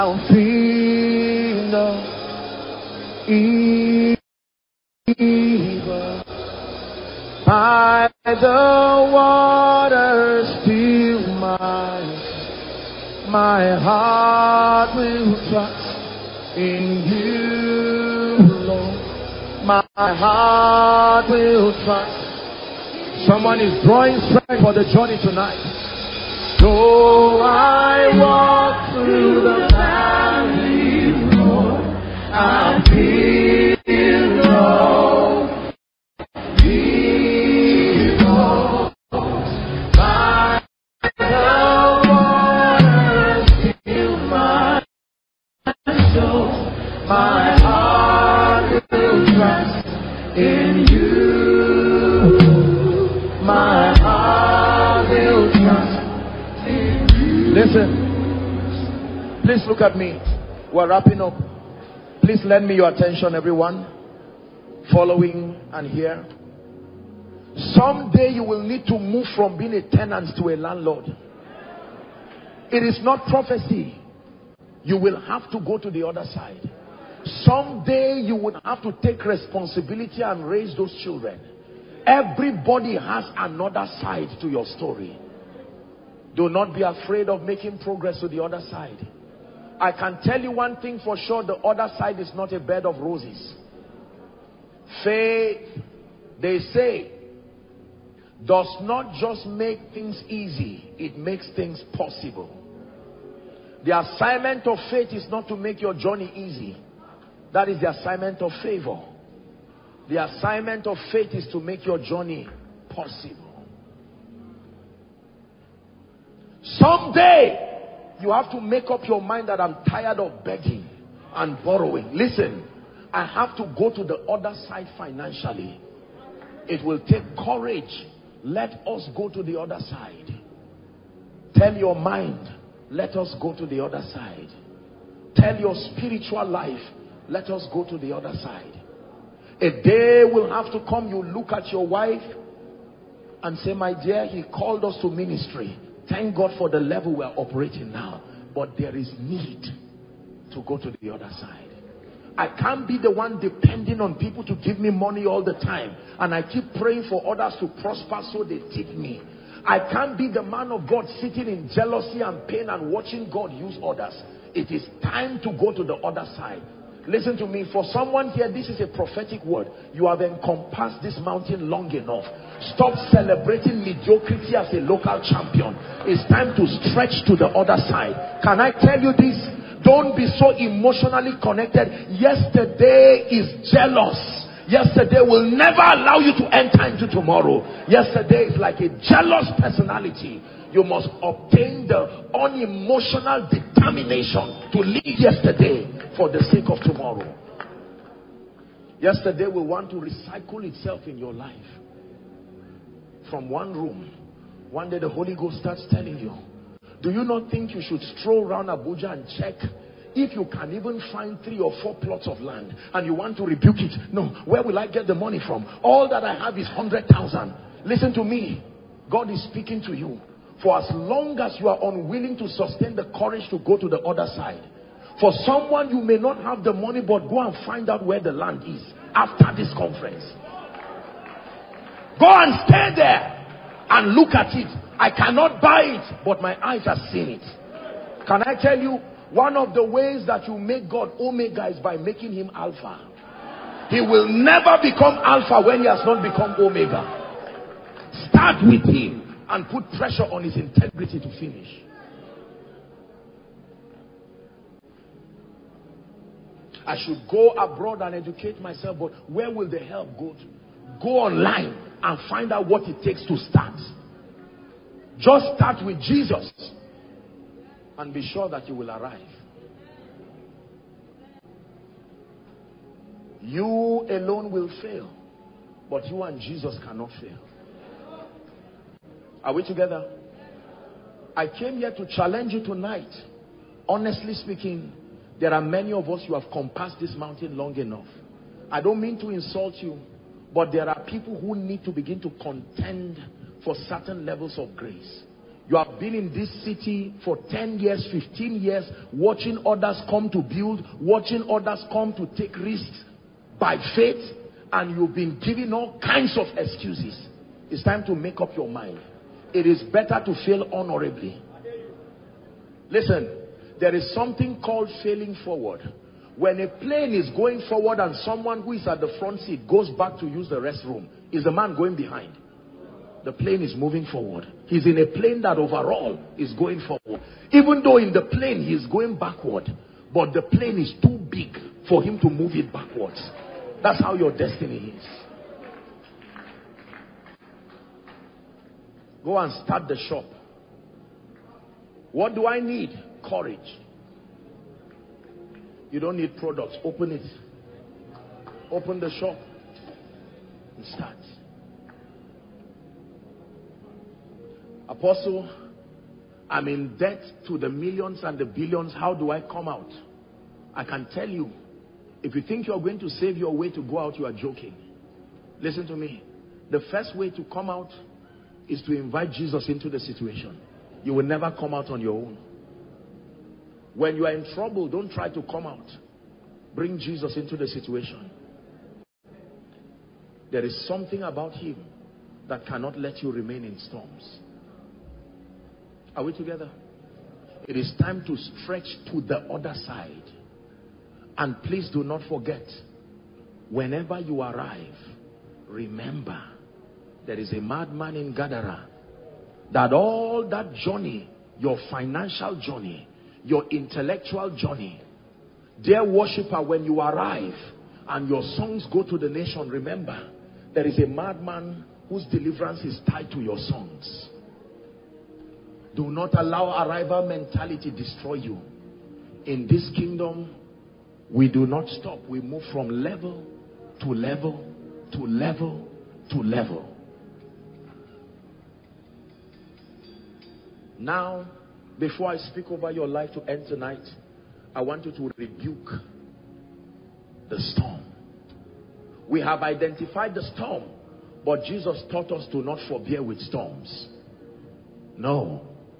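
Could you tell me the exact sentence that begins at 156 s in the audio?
And I keep praying for others to prosper so they tip me.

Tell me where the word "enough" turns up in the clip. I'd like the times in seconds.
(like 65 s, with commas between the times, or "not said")
171 s, 287 s.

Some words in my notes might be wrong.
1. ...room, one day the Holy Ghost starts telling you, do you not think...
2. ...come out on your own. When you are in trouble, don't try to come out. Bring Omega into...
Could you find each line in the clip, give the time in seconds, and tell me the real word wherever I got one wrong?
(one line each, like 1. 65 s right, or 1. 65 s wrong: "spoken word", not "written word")
1. 203 s right
2. 371 s wrong: "Jesus", not "Omega".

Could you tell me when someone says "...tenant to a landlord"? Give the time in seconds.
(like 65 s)
69 s.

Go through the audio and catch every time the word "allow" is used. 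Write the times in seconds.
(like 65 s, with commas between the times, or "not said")
185 s, 416 s.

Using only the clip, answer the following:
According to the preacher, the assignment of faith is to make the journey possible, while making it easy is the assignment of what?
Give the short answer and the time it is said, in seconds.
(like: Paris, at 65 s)
Favor, at 108 s.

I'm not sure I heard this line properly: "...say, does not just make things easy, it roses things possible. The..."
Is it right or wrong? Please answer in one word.
wrong.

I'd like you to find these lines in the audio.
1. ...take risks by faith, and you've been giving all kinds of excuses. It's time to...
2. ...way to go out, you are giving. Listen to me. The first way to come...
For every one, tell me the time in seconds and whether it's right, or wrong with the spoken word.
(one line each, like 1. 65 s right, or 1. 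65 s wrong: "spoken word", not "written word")
1. 302 s right
2. 363 s wrong: "joking", not "giving".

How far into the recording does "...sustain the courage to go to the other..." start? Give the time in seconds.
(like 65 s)
222 s.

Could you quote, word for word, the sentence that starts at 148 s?
But there is need to go to the other side.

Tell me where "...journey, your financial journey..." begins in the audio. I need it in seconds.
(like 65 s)
400 s.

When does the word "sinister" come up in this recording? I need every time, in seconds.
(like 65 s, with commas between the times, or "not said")
not said.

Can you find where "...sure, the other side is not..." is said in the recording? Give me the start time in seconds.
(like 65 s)
91 s.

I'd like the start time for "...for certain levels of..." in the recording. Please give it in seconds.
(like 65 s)
293 s.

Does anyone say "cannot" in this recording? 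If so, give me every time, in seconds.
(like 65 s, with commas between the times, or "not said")
235 s, 276 s, 382 s.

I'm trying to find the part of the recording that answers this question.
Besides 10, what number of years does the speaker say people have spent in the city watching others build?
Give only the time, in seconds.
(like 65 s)
298 s.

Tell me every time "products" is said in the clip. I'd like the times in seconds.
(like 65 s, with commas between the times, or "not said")
346 s.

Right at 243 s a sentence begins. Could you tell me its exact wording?
He will never become Alpha when he has not become Omega.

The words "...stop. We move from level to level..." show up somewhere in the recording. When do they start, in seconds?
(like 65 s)
421 s.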